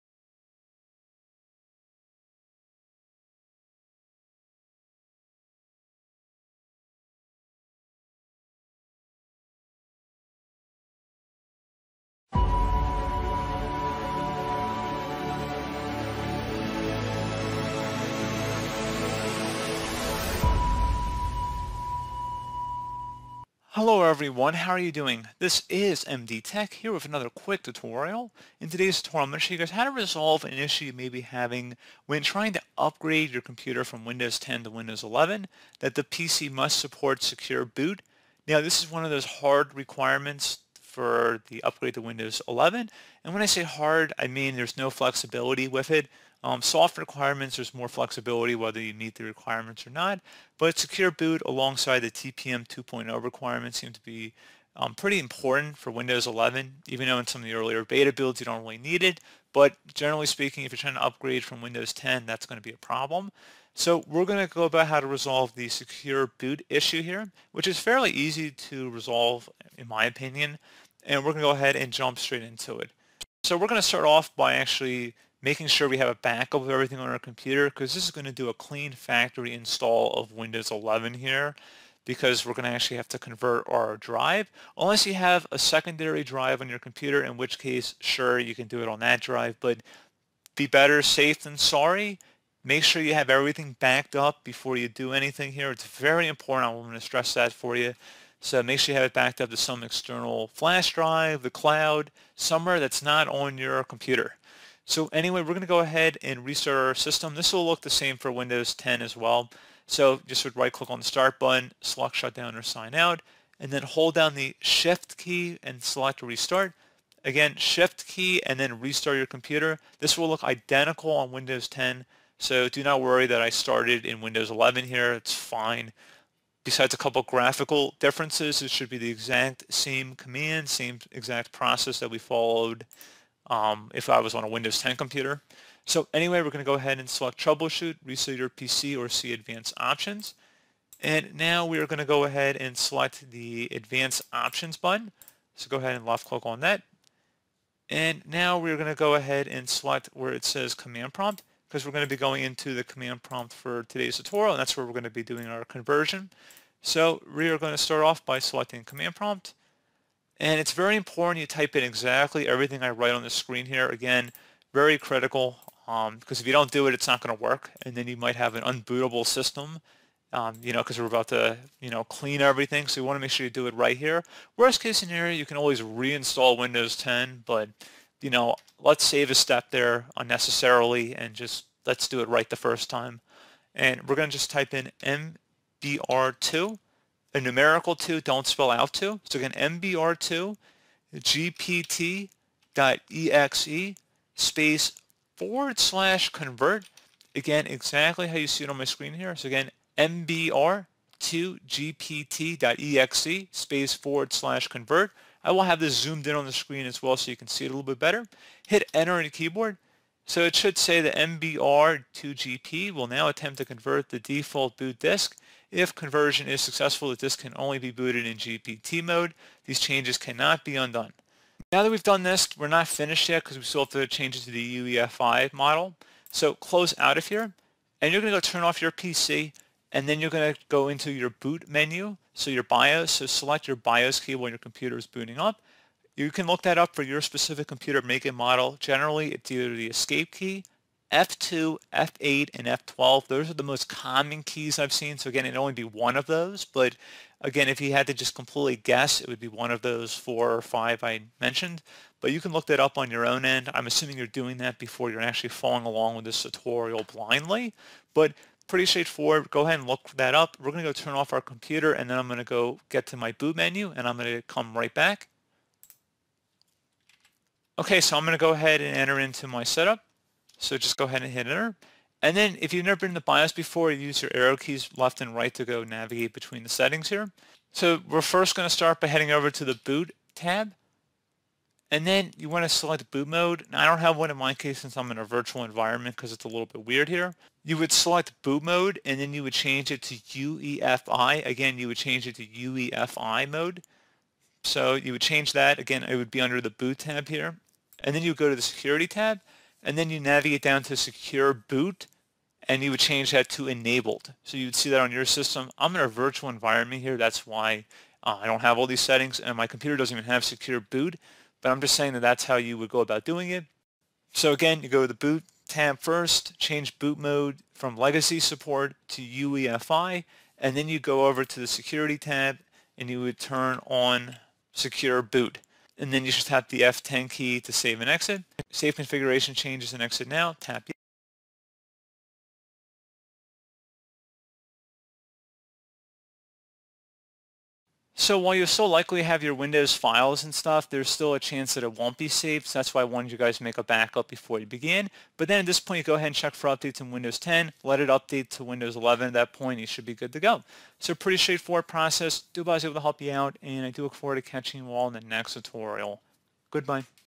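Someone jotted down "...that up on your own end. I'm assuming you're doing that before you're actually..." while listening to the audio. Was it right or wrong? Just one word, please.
right.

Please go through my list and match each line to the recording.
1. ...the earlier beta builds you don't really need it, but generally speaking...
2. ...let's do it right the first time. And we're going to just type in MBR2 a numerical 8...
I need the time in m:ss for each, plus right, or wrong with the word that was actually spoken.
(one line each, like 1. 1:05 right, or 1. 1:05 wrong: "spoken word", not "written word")
1. 0:57 right
2. 3:01 wrong: "2", not "8".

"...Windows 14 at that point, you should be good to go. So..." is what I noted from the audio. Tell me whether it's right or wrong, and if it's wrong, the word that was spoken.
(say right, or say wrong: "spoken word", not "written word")
wrong: "11", not "14".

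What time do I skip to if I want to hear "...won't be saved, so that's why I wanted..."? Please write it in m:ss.
5:41.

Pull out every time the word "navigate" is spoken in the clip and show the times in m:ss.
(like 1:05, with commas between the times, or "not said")
4:35, 5:00.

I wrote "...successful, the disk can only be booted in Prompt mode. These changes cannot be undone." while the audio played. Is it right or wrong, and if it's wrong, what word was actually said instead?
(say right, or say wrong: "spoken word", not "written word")
wrong: "GPT", not "Prompt".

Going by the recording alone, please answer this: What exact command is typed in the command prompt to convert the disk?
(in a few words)
MBR2GPT.exe /convert.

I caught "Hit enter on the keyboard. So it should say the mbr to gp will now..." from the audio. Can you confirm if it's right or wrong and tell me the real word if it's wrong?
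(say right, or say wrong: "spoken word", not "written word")
right.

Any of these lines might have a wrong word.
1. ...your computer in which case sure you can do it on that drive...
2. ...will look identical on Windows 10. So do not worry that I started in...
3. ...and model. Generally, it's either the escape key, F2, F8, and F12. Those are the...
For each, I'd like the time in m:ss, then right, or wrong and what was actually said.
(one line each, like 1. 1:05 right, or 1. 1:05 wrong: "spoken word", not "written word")
1. 1:26 right
2. 2:00 right
3. 3:58 right.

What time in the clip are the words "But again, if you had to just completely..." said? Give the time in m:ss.
4:06.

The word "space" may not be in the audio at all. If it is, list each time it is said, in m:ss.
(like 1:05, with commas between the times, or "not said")
3:14, 3:23.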